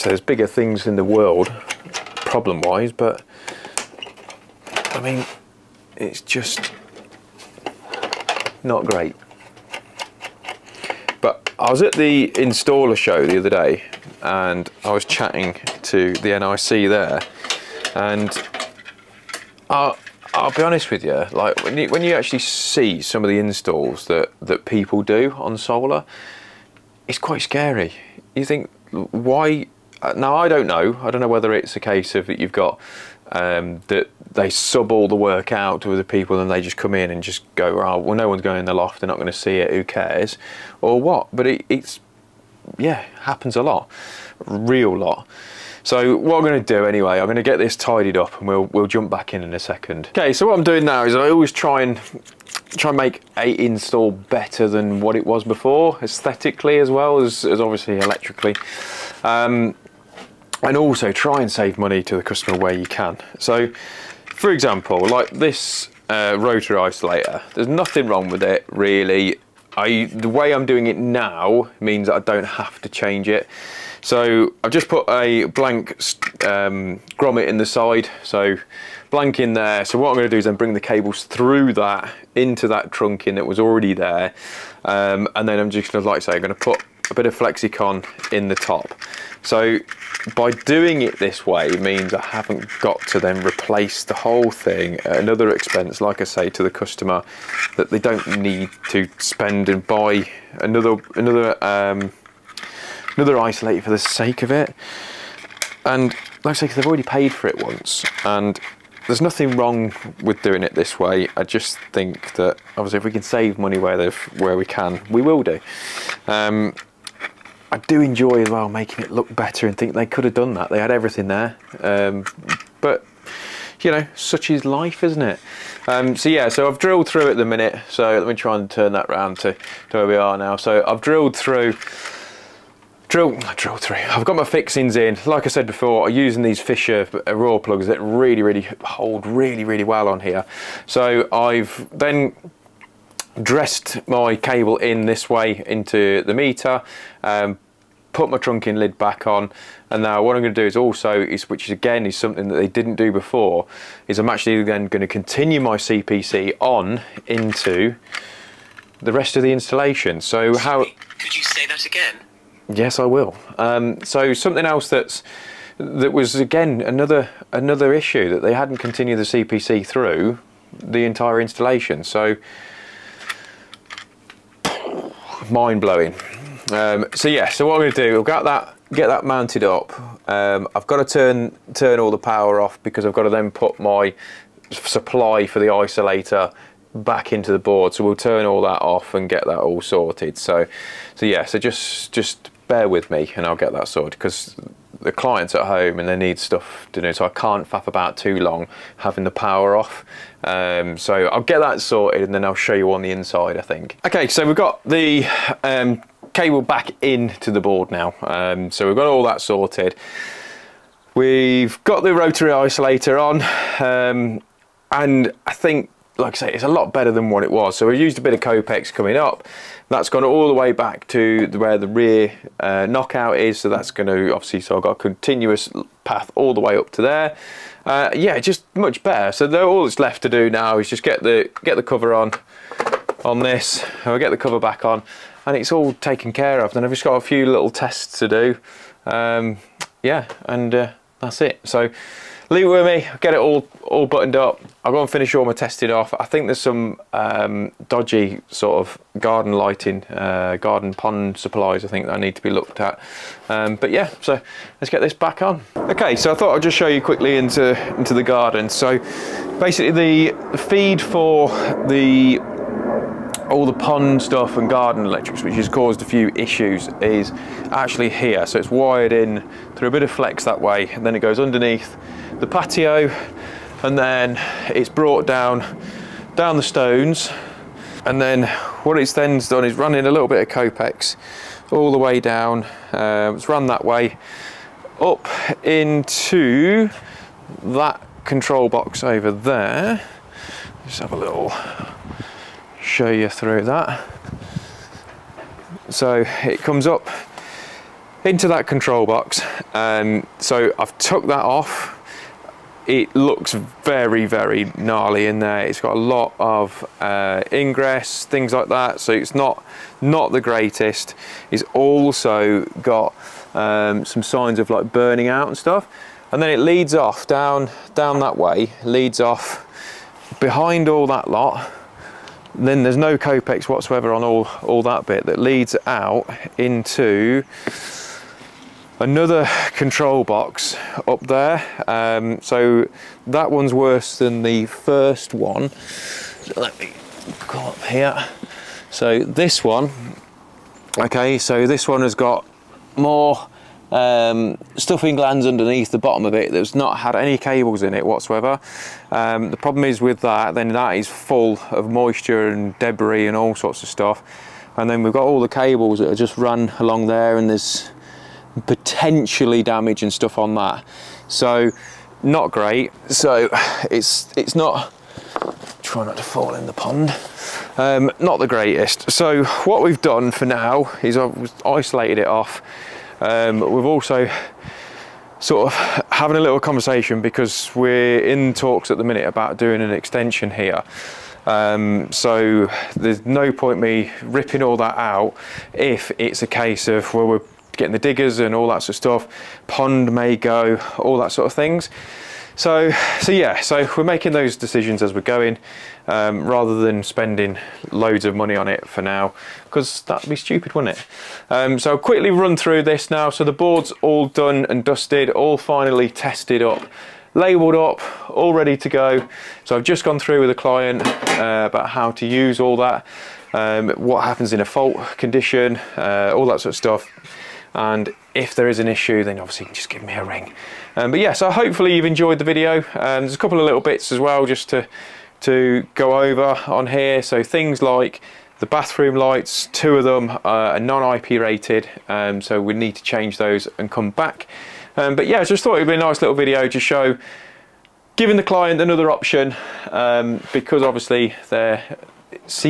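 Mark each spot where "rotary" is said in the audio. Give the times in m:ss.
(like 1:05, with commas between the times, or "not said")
1:06, 3:32.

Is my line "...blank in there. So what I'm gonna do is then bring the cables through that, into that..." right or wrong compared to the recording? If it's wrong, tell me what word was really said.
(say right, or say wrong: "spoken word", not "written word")
right.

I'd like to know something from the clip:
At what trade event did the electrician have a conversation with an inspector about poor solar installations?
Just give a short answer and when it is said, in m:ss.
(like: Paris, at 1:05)
installer show, at 0:12.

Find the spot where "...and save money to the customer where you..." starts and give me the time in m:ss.
1:01.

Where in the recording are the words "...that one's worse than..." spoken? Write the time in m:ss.
5:33.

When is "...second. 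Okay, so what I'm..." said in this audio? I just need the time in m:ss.
0:49.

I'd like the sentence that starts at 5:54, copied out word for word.
And then we've got all the cables that are just run along there and there's potentially damage and stuff on that.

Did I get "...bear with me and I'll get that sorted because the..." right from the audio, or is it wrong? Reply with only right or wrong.
right.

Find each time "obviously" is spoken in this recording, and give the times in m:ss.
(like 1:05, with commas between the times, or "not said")
0:57, 1:52, 3:44, 6:59, 7:20.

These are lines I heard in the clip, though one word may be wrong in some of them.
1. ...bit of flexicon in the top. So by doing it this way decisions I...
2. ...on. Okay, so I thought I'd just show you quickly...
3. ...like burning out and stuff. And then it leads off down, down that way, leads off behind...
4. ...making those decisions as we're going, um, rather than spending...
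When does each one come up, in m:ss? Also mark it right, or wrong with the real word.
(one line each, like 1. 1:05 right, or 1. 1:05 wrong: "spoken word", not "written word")
1. 1:27 wrong: "means", not "decisions"
2. 4:15 right
3. 5:14 right
4. 6:34 right.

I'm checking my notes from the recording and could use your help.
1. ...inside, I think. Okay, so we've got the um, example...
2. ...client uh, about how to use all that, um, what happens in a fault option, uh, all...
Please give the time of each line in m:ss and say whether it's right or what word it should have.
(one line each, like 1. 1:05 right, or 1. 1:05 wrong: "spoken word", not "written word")
1. 3:23 wrong: "cable", not "example"
2. 6:50 wrong: "condition", not "option".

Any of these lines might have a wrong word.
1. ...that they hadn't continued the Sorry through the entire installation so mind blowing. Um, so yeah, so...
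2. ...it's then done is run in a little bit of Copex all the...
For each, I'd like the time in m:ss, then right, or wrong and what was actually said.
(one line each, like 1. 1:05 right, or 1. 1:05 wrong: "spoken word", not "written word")
1. 2:48 wrong: "CPC", not "Sorry"
2. 4:38 right.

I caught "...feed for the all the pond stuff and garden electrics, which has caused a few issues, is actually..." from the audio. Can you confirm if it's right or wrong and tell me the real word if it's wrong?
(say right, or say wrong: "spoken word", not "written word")
right.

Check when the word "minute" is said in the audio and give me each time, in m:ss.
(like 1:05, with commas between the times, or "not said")
2:07, 6:19.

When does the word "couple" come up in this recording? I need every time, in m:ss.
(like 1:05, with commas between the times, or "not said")
7:03.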